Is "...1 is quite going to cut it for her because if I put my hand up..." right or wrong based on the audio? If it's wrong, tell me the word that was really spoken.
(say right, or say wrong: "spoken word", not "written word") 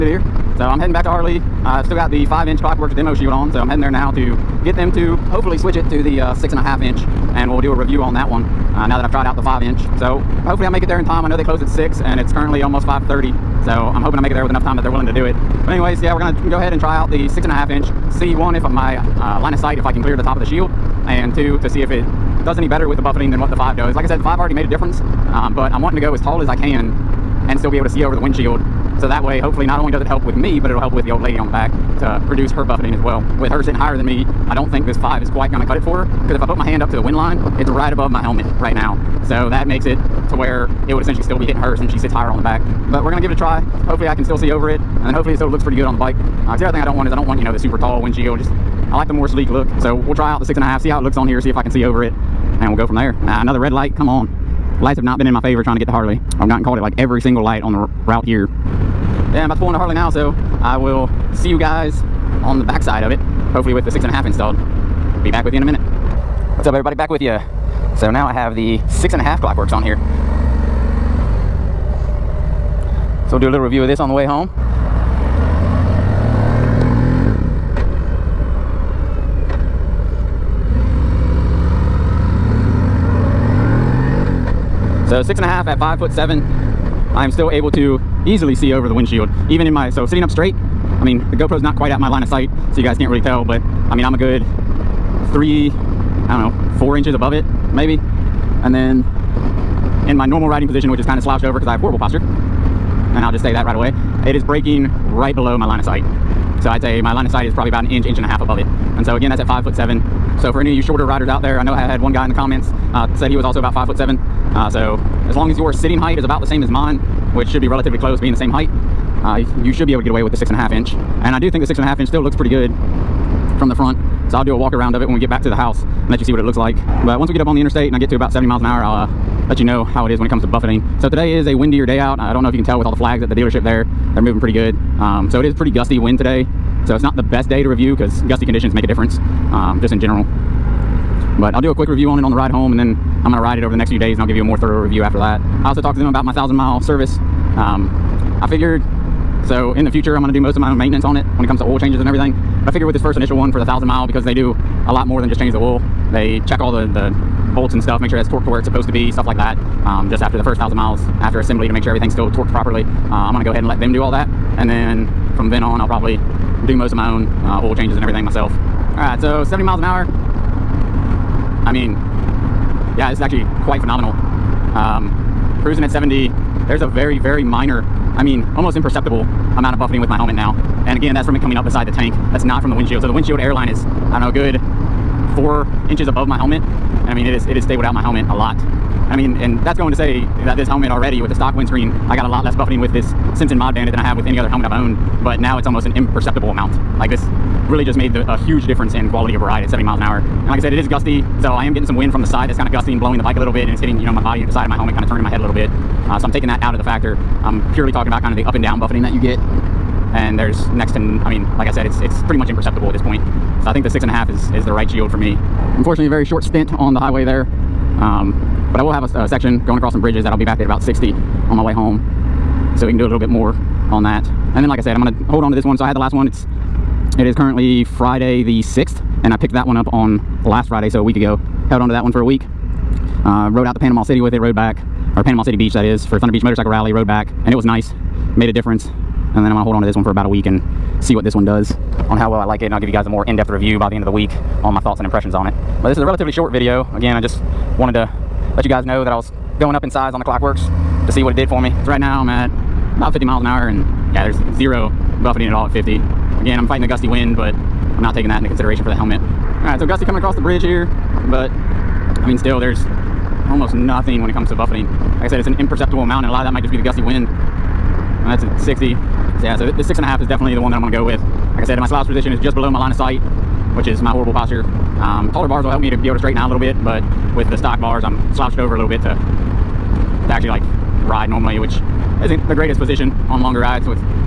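wrong: "5", not "1".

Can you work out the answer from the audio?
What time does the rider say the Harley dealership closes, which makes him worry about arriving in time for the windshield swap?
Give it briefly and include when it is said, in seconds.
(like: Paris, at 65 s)
6, at 11 s.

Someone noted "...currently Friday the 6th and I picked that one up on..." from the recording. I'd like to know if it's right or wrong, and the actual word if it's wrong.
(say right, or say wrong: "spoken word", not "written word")
right.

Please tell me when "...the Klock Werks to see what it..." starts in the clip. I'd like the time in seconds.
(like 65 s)
250 s.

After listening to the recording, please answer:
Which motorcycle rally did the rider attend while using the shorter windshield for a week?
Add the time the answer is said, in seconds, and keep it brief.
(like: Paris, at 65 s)
Thunder Beach Motorcycle Rally, at 236 s.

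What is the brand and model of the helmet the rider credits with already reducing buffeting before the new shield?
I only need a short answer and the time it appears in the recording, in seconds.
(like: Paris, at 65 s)
Simpson Mod Bandit, at 193 s.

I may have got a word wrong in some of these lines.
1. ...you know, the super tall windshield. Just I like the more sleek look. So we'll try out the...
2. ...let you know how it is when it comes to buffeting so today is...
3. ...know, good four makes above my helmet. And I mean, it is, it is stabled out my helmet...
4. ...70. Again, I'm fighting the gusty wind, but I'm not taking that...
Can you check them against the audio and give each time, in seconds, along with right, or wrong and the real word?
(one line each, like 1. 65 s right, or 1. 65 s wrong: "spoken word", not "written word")
1. 47 s right
2. 129 s right
3. 184 s wrong: "inches", not "makes"
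4. 255 s wrong: "50", not "70".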